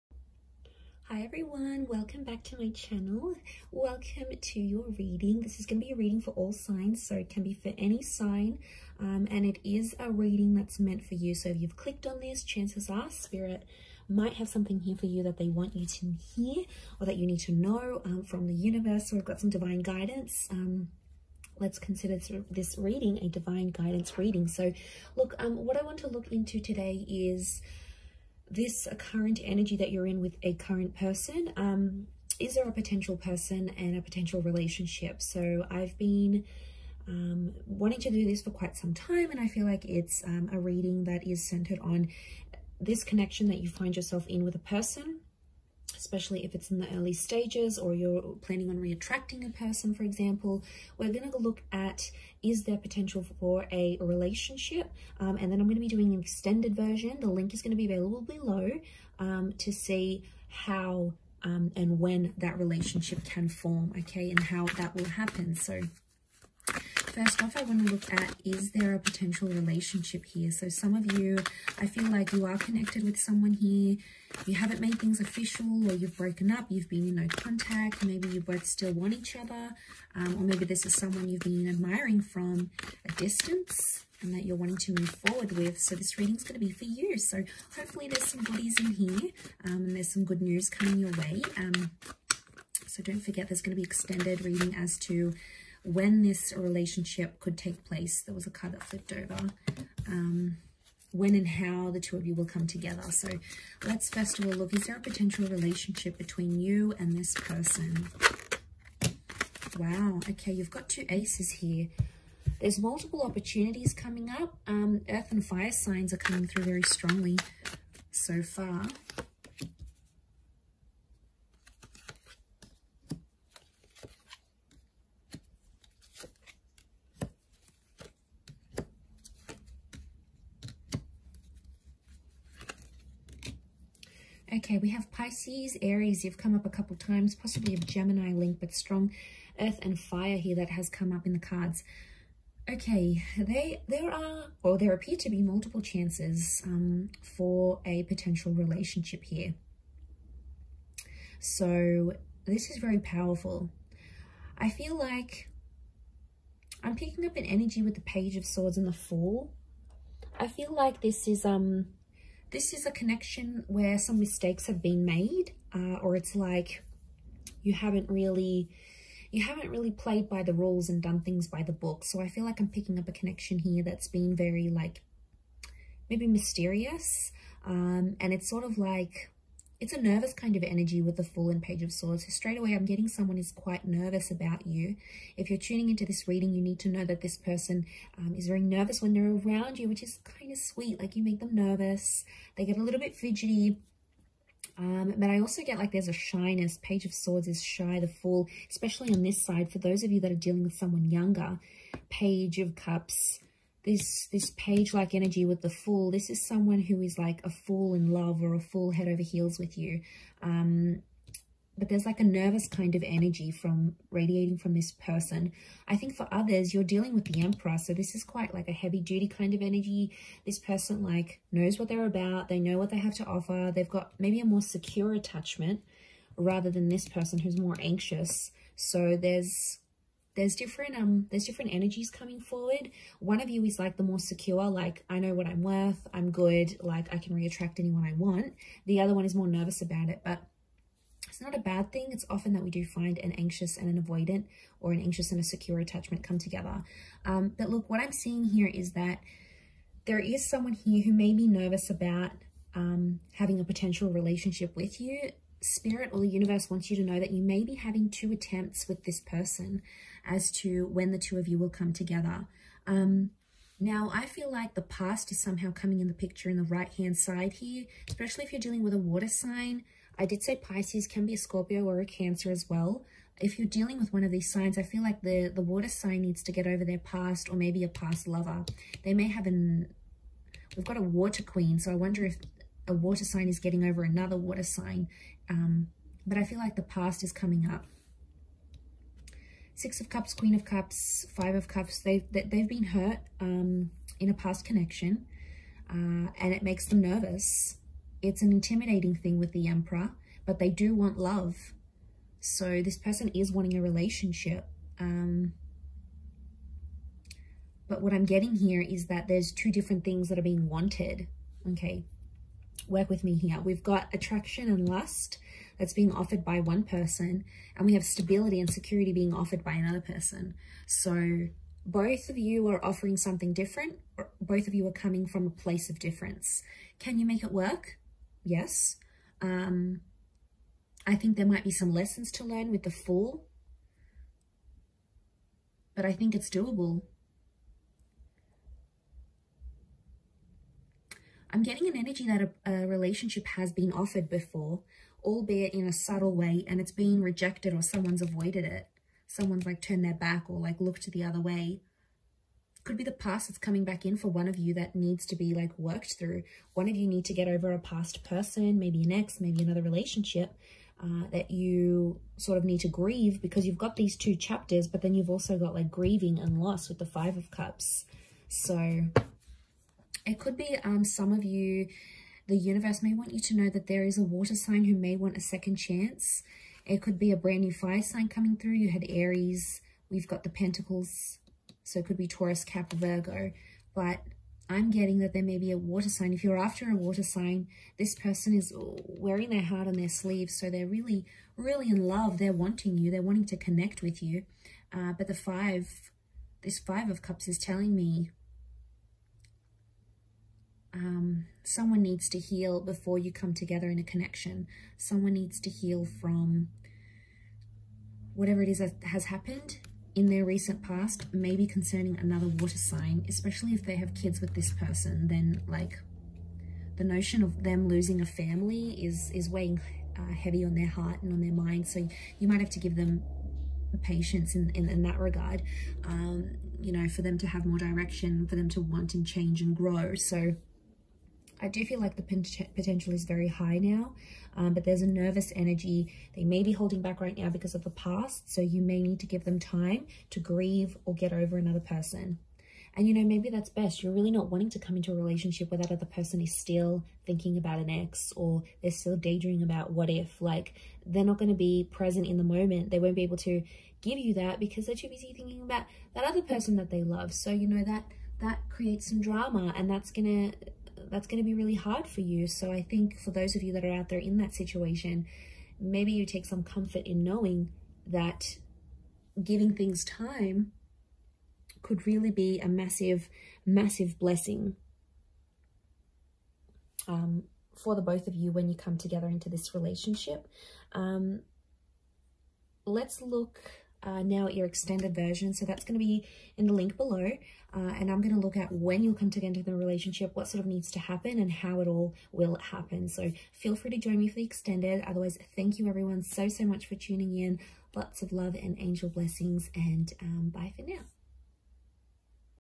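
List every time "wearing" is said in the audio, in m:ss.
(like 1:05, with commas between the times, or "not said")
6:28.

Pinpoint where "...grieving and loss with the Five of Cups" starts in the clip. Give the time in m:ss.
6:05.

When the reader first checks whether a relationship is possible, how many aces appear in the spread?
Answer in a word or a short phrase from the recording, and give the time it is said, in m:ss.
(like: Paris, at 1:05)
2, at 1:50.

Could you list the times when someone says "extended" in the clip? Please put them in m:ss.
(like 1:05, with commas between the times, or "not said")
0:56, 1:33, 8:04, 8:14.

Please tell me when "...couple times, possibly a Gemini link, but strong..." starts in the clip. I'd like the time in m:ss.
2:16.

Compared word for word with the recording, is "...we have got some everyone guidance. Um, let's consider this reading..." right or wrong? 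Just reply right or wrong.
wrong.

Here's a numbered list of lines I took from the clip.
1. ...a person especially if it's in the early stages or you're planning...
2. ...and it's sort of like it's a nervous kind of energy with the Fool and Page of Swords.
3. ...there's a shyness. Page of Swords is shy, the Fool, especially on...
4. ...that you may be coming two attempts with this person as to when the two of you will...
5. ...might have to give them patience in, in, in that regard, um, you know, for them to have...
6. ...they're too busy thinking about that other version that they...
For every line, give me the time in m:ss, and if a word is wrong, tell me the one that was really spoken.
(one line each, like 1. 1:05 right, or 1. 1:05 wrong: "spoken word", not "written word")
1. 0:44 right
2. 2:58 right
3. 3:15 right
4. 4:17 wrong: "having", not "coming"
5. 7:02 right
6. 7:34 wrong: "person", not "version".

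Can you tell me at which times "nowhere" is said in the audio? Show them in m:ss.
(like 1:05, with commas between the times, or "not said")
not said.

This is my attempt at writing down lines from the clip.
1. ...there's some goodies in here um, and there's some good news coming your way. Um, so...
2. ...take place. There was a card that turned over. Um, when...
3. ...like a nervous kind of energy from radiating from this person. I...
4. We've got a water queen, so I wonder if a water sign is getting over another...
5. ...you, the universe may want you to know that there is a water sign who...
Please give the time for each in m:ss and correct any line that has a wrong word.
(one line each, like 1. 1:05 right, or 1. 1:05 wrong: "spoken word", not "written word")
1. 1:28 right
2. 1:37 wrong: "flipped", not "turned"
3. 3:32 right
4. 4:40 right
5. 6:11 right.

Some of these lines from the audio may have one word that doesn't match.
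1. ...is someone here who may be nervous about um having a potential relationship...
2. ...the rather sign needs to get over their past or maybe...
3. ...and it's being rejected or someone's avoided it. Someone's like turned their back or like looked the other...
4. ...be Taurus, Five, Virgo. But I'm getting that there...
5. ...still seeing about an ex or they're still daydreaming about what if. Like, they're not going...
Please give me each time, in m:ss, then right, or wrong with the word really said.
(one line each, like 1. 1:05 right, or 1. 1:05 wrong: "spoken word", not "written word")
1. 4:10 right
2. 4:35 wrong: "water", not "rather"
3. 5:46 right
4. 6:22 wrong: "Cap", not "Five"
5. 7:26 wrong: "thinking", not "seeing".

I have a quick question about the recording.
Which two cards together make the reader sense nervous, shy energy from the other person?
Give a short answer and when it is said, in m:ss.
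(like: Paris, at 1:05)
Page of Swords and the Fool, at 2:38.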